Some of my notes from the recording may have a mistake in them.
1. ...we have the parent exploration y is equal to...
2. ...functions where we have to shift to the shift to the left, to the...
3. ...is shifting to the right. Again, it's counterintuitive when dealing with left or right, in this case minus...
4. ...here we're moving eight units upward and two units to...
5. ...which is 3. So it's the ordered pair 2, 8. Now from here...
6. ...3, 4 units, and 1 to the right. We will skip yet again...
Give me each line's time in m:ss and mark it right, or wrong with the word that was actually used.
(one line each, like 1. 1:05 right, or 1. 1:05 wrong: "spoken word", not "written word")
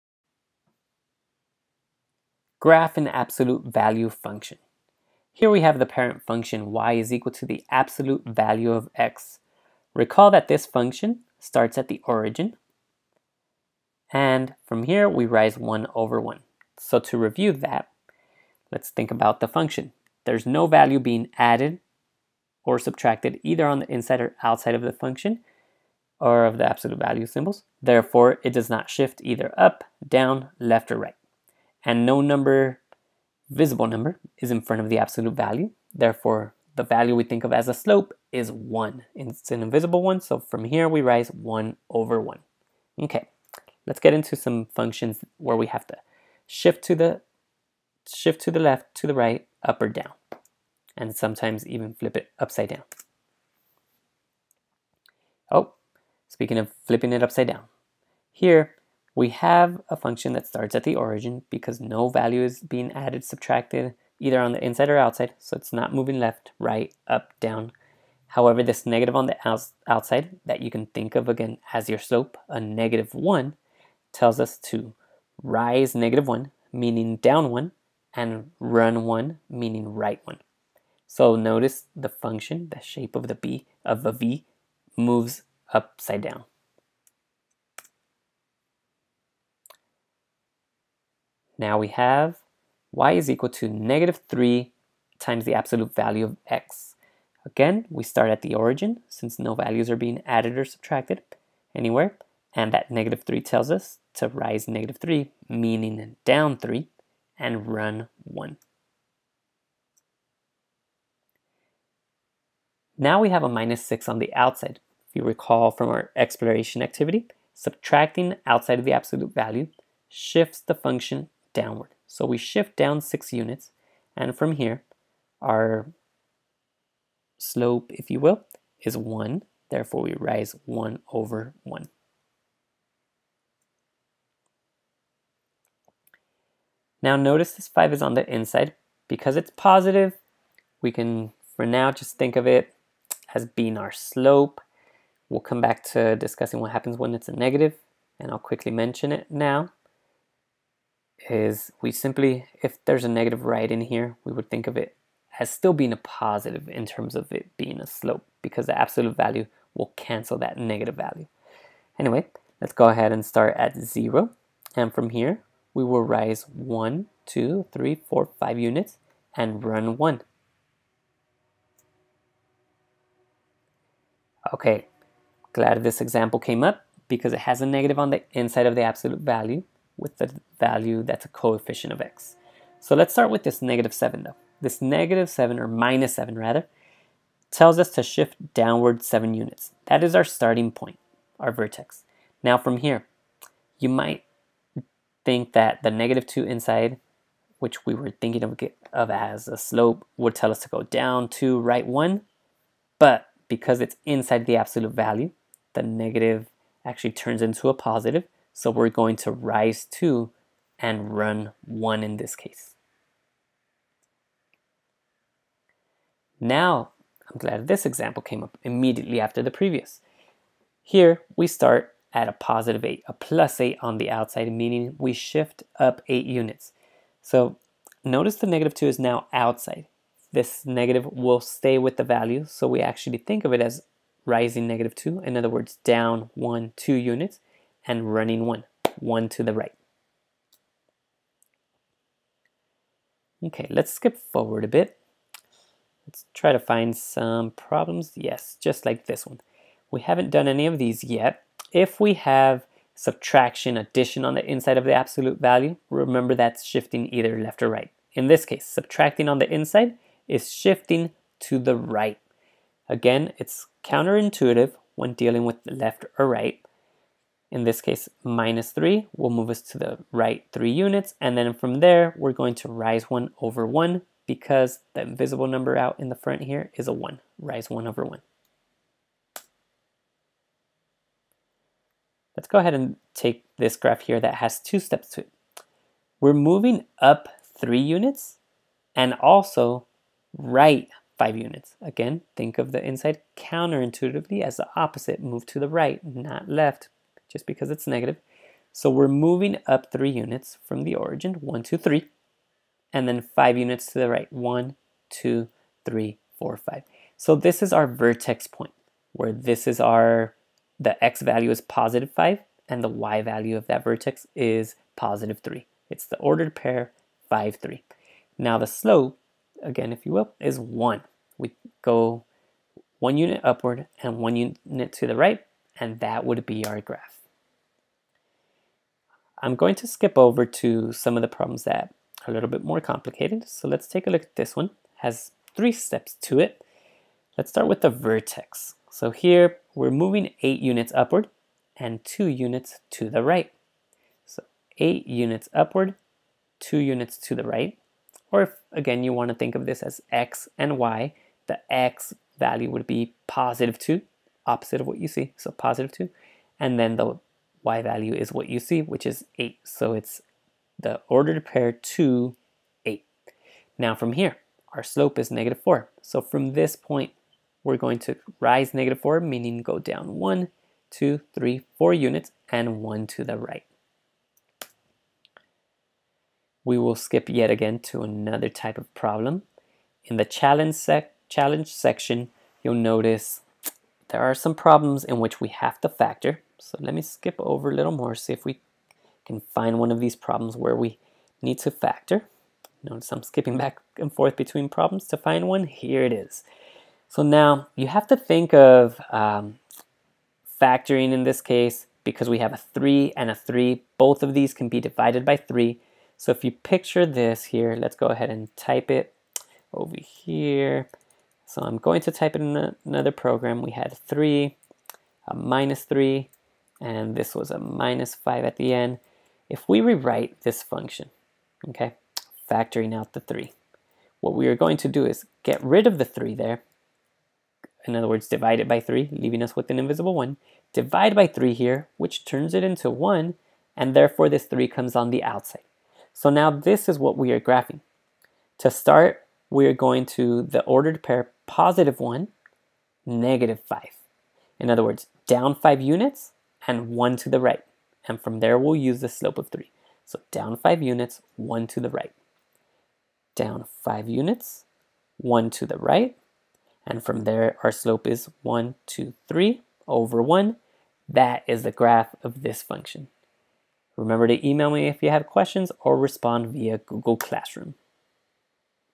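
1. 0:05 wrong: "function", not "exploration"
2. 0:44 right
3. 4:20 right
4. 5:39 right
5. 5:58 wrong: "8", not "3"
6. 6:11 right.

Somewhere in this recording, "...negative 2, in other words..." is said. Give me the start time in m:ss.
3:54.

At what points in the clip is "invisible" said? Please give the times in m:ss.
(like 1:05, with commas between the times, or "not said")
0:39, 4:35, 7:09.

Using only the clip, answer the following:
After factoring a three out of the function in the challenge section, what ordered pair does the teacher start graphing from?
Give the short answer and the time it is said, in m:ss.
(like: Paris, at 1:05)
(1, -5), at 7:21.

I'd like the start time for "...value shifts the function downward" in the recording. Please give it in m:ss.
1:59.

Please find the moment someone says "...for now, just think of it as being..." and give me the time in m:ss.
2:21.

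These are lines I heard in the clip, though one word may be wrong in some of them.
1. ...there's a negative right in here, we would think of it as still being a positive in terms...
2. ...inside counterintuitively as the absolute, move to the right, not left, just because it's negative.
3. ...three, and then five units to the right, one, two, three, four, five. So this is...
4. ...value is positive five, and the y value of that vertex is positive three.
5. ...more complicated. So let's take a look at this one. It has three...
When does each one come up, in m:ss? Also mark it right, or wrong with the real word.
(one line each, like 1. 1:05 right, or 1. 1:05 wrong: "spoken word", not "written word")
1. 2:32 right
2. 4:52 wrong: "opposite", not "absolute"
3. 5:01 right
4. 5:11 right
5. 5:32 right.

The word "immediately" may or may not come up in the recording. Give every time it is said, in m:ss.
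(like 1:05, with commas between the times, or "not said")
3:38.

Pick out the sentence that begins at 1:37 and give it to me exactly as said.
Again, we start at the origin since no values are being added or subtracted anywhere.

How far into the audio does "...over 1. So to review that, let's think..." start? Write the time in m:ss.
0:15.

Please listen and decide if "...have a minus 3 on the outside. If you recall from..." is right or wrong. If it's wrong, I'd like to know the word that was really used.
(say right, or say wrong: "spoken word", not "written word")
wrong: "6", not "3".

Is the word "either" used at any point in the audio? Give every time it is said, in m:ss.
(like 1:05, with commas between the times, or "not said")
0:23, 0:29, 1:04, 4:17.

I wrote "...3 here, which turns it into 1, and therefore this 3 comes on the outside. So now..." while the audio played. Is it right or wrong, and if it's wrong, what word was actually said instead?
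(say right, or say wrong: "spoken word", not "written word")
right.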